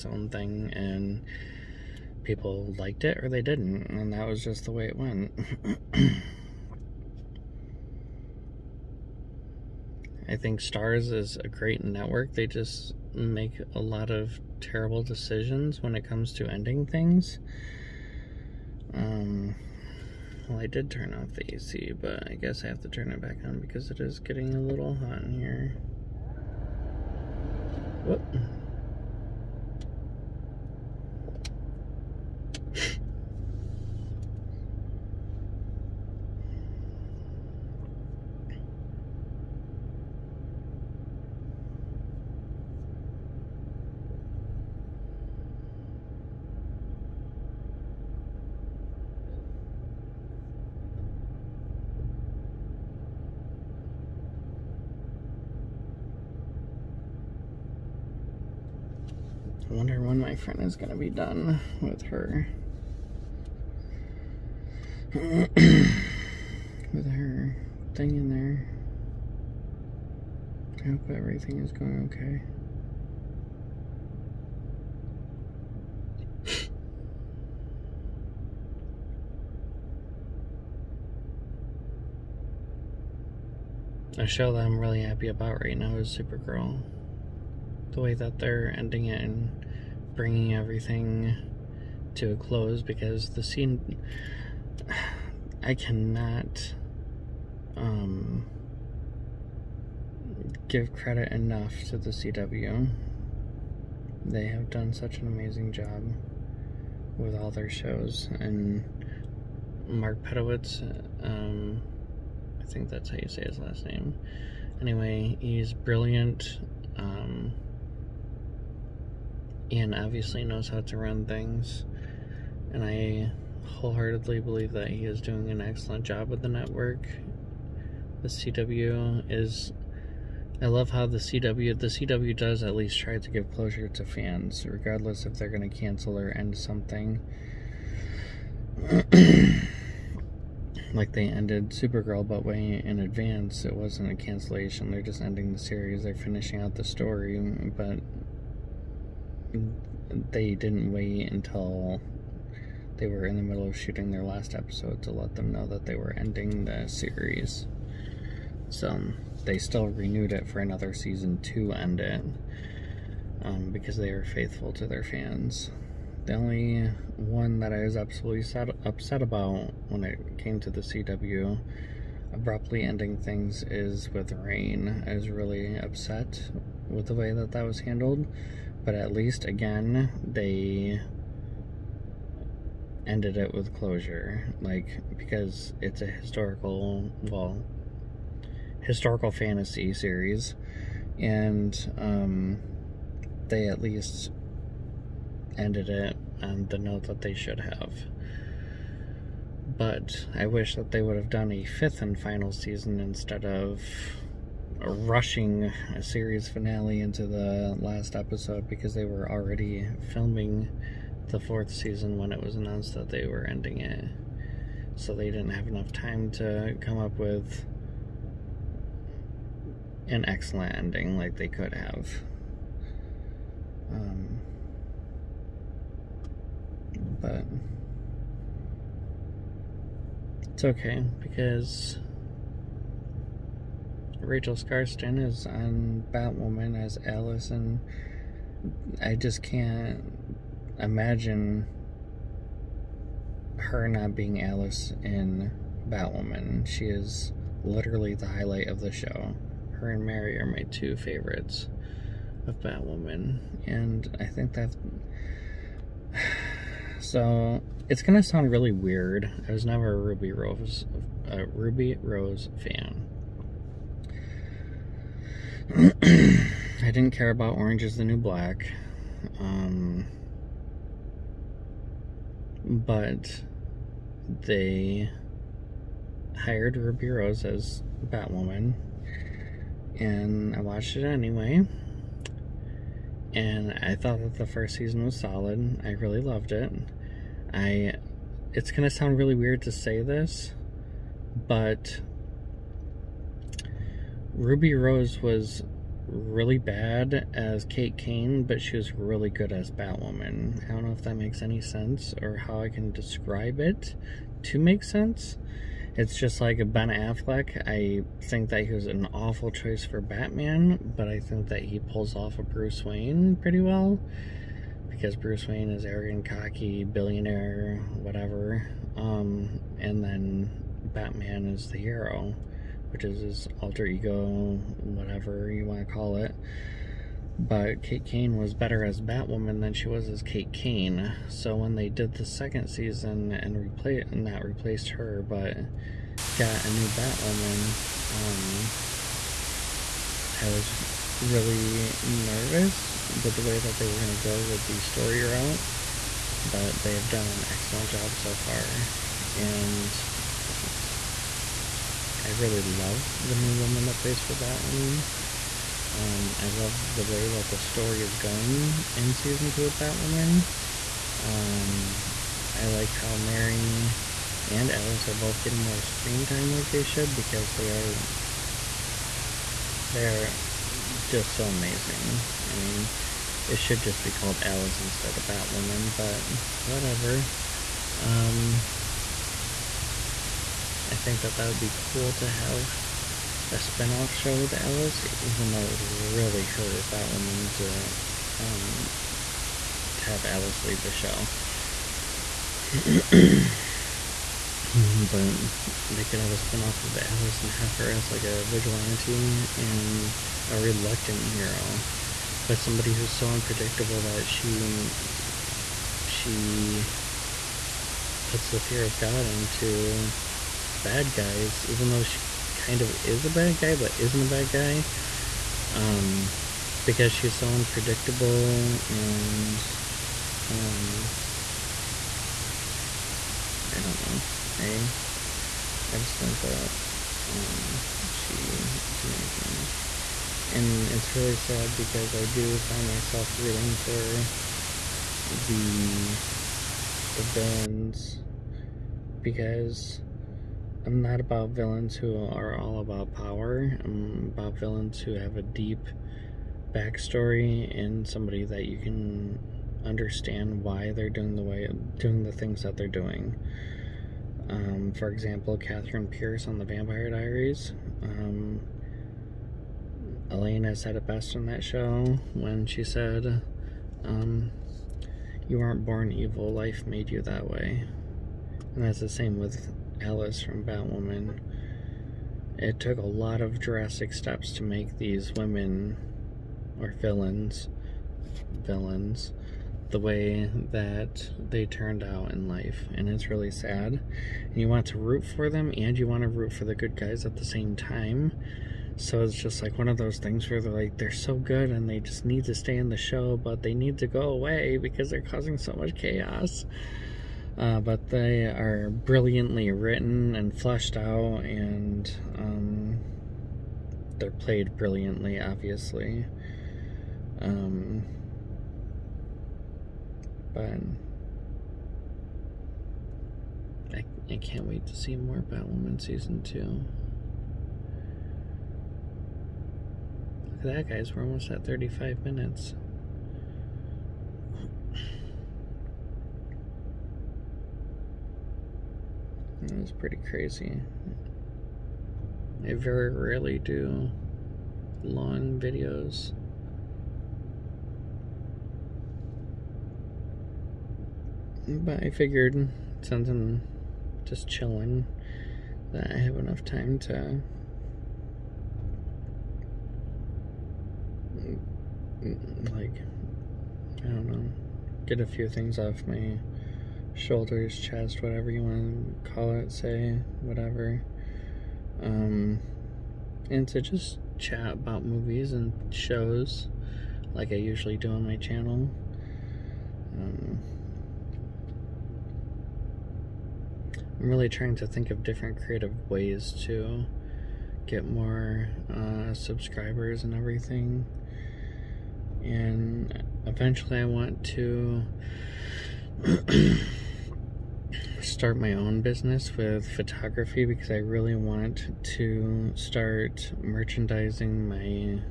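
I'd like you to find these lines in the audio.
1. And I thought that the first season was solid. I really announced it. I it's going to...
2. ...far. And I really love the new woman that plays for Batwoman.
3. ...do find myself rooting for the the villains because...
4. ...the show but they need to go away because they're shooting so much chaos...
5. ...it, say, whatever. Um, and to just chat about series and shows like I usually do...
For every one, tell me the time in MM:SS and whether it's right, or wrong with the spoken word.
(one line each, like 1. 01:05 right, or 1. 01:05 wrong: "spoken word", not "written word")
1. 04:43 wrong: "loved", not "announced"
2. 05:48 right
3. 07:12 right
4. 08:12 wrong: "causing", not "shooting"
5. 09:19 wrong: "movies", not "series".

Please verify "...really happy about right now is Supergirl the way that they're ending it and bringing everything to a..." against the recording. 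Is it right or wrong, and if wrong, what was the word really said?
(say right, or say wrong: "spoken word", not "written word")
right.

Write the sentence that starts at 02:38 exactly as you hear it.
So they still renewed it for another season to end it um, because they are faithful to their fans.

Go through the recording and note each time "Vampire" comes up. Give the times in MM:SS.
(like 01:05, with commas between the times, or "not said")
07:36.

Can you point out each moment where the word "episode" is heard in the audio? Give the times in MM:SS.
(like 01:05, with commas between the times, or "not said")
02:34, 03:28.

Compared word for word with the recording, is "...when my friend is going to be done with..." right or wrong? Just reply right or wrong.
right.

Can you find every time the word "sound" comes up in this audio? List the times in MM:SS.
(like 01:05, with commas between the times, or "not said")
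04:18, 04:48.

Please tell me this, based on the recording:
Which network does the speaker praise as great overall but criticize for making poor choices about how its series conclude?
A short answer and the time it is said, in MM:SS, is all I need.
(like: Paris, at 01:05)
Starz, at 00:10.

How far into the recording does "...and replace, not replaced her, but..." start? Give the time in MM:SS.
05:33.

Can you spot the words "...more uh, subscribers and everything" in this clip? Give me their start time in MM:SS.
09:38.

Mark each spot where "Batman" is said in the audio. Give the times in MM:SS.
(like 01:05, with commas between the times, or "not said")
05:09, 05:20.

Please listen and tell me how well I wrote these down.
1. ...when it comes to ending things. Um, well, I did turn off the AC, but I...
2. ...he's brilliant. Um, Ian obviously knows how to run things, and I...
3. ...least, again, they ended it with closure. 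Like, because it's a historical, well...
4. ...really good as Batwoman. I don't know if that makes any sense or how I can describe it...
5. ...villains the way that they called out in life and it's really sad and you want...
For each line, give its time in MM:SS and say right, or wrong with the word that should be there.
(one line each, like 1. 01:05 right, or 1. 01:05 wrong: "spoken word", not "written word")
1. 00:15 right
2. 01:55 right
3. 02:59 right
4. 04:58 right
5. 07:58 wrong: "turned", not "called".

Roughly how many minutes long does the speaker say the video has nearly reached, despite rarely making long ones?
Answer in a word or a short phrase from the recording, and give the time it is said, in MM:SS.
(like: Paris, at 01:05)
35, at 08:41.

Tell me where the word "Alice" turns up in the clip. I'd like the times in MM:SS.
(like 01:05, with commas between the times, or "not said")
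03:57, 04:04, 06:04, 06:14, 06:24, 06:30, 06:36, 07:50.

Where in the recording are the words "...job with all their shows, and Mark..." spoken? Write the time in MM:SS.
01:45.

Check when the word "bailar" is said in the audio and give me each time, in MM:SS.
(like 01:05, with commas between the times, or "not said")
not said.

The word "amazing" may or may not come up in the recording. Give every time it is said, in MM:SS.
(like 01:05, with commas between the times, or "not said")
01:45, 06:11, 07:09.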